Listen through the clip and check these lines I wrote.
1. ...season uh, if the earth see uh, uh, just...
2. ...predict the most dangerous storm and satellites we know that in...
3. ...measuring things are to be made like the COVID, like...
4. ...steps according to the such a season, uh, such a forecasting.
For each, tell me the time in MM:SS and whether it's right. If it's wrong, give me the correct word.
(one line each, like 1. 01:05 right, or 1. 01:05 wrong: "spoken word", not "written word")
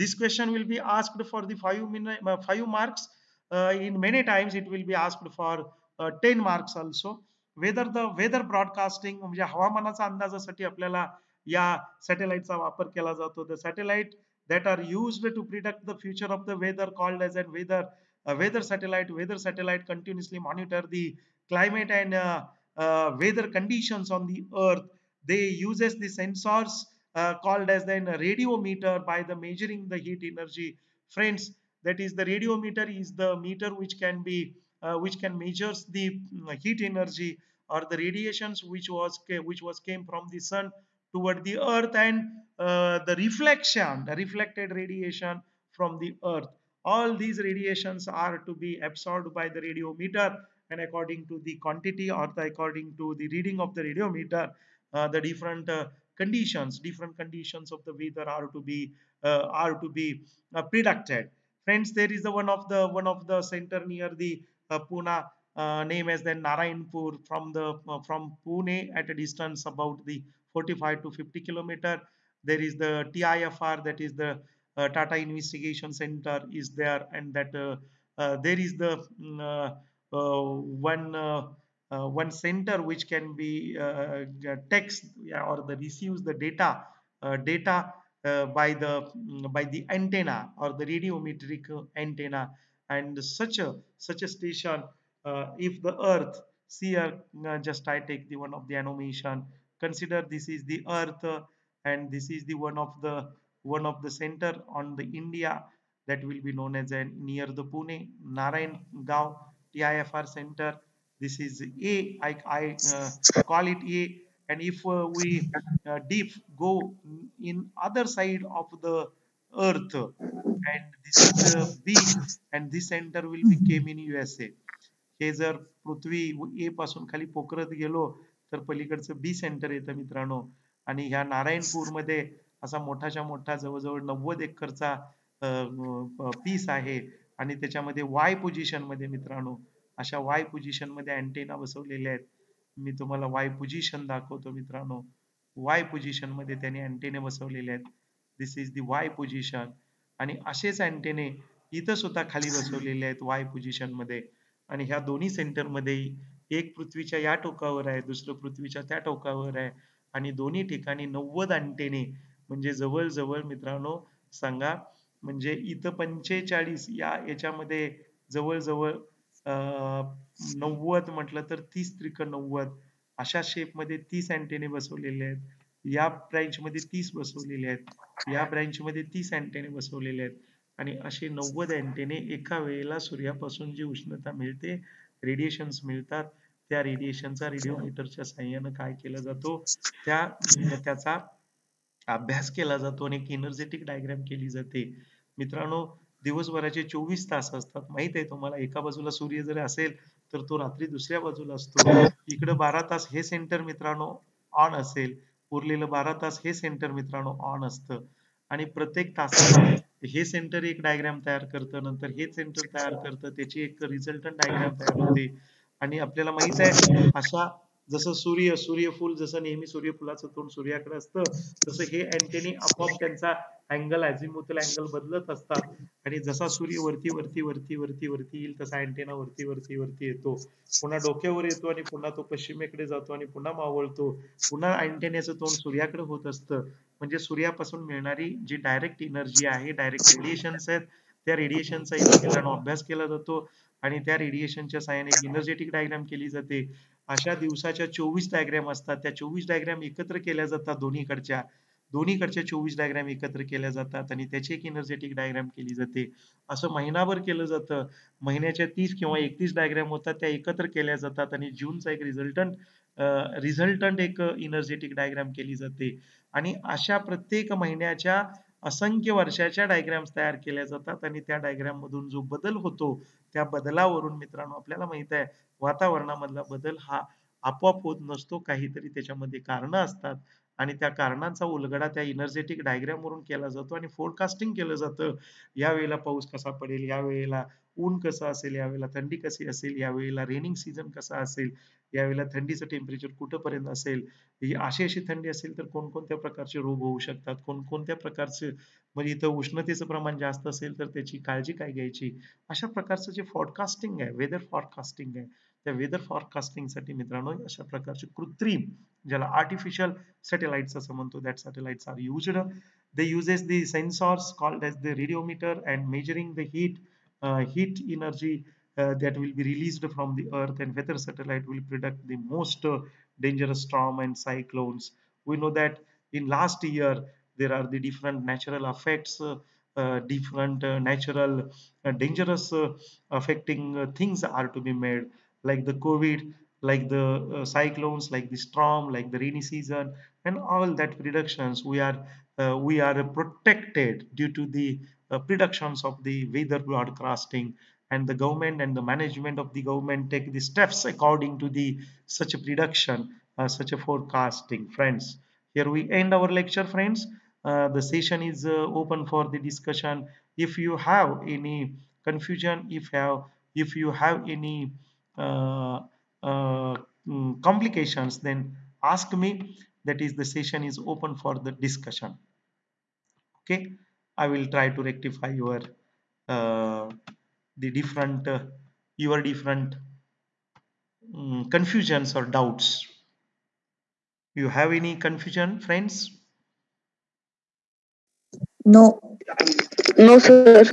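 1. 01:34 wrong: "station", not "season"
2. 05:21 wrong: "cyclones", not "satellites"
3. 05:33 wrong: "affecting", not "measuring"
4. 05:50 wrong: "prediction", not "season".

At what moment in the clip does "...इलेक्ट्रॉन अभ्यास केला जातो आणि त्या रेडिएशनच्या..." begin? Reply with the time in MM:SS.
04:01.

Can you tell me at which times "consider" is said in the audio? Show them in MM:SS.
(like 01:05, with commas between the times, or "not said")
01:39.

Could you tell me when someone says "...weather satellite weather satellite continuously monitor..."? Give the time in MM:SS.
00:18.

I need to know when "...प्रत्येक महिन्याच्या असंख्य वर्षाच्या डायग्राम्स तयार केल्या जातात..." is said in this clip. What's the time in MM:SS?
04:27.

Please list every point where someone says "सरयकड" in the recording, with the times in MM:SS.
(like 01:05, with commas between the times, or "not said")
03:40, 03:55.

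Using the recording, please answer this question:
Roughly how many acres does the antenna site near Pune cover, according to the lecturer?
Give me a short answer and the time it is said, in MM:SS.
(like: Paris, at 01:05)
90 acres, at 02:14.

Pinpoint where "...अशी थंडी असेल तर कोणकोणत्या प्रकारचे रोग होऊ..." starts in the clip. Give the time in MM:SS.
04:54.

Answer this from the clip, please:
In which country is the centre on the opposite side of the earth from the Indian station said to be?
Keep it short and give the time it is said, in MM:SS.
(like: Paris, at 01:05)
USA, at 02:04.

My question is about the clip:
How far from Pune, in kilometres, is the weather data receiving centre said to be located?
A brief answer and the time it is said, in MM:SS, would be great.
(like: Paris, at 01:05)
45 to 50 km, at 01:10.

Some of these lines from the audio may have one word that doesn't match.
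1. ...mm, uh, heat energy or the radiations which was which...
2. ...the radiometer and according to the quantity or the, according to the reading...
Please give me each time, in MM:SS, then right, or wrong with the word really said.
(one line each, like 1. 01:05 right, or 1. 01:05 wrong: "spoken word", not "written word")
1. 00:36 right
2. 00:49 right.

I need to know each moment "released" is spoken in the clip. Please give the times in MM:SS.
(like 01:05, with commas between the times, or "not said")
05:19.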